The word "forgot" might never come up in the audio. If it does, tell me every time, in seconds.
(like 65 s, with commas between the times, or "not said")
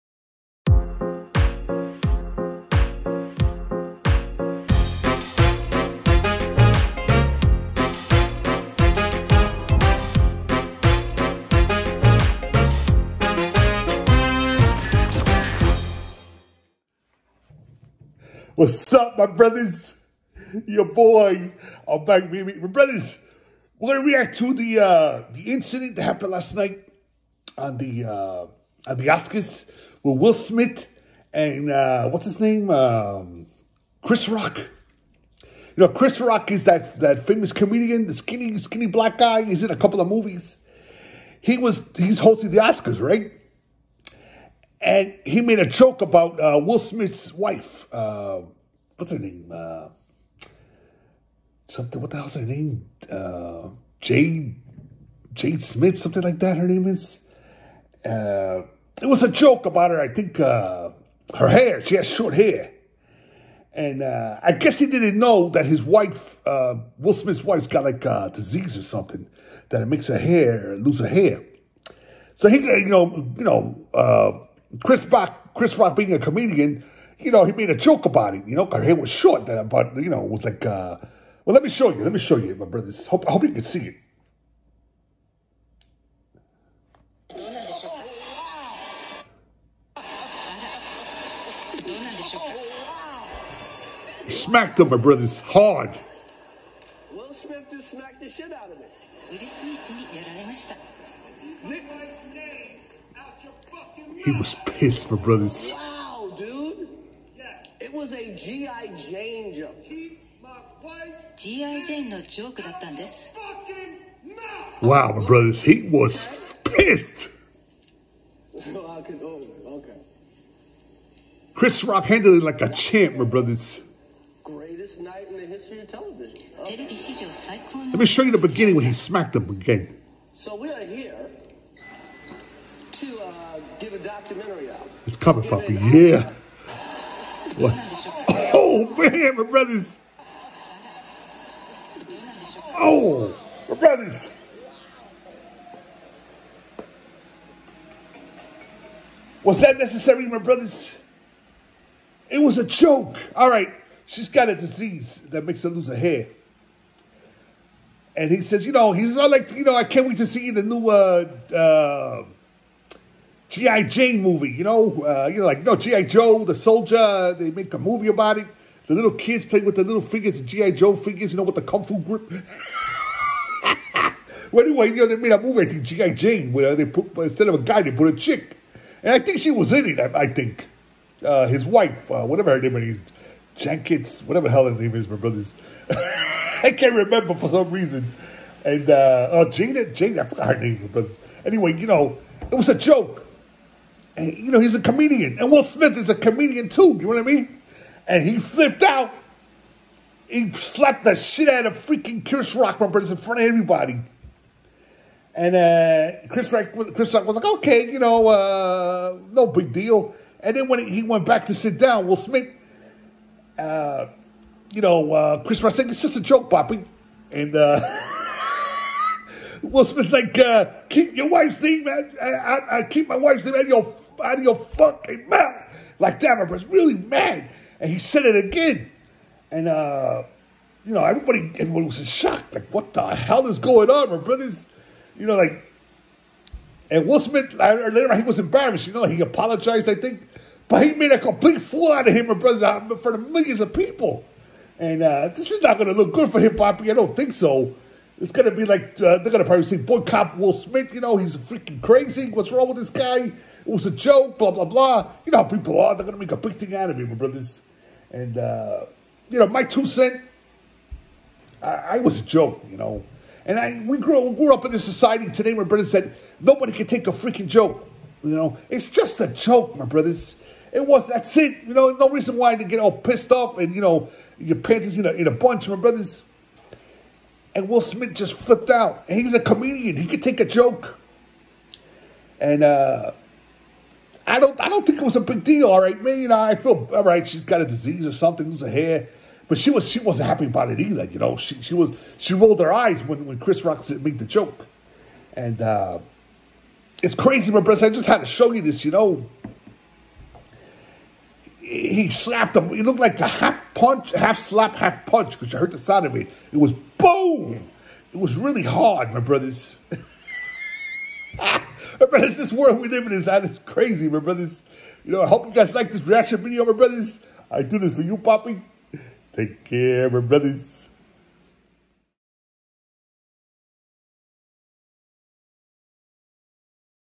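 190 s.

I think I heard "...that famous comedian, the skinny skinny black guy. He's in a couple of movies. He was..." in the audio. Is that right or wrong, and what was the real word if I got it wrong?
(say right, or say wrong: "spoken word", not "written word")
right.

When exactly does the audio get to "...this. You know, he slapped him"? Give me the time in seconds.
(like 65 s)
298 s.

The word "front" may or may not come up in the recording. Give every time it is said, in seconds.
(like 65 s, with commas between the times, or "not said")
203 s, 242 s.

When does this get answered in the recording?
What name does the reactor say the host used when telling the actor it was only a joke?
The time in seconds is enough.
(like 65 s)
216 s.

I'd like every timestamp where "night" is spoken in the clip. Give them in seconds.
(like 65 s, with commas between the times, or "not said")
26 s, 125 s.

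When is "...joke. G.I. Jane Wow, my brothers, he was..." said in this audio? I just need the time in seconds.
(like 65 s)
109 s.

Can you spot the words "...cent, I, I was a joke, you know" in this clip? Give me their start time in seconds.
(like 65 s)
259 s.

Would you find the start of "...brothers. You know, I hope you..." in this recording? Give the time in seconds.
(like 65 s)
314 s.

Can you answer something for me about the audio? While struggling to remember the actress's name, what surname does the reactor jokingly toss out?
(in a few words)
Jenkins.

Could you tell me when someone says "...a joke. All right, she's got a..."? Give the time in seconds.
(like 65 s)
152 s.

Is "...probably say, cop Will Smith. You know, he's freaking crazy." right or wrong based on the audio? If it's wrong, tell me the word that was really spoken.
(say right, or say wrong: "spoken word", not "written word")
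right.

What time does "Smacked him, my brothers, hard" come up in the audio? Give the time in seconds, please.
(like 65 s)
94 s.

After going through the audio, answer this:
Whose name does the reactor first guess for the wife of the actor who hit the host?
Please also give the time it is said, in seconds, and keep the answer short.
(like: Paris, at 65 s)
Jade Smith, at 53 s.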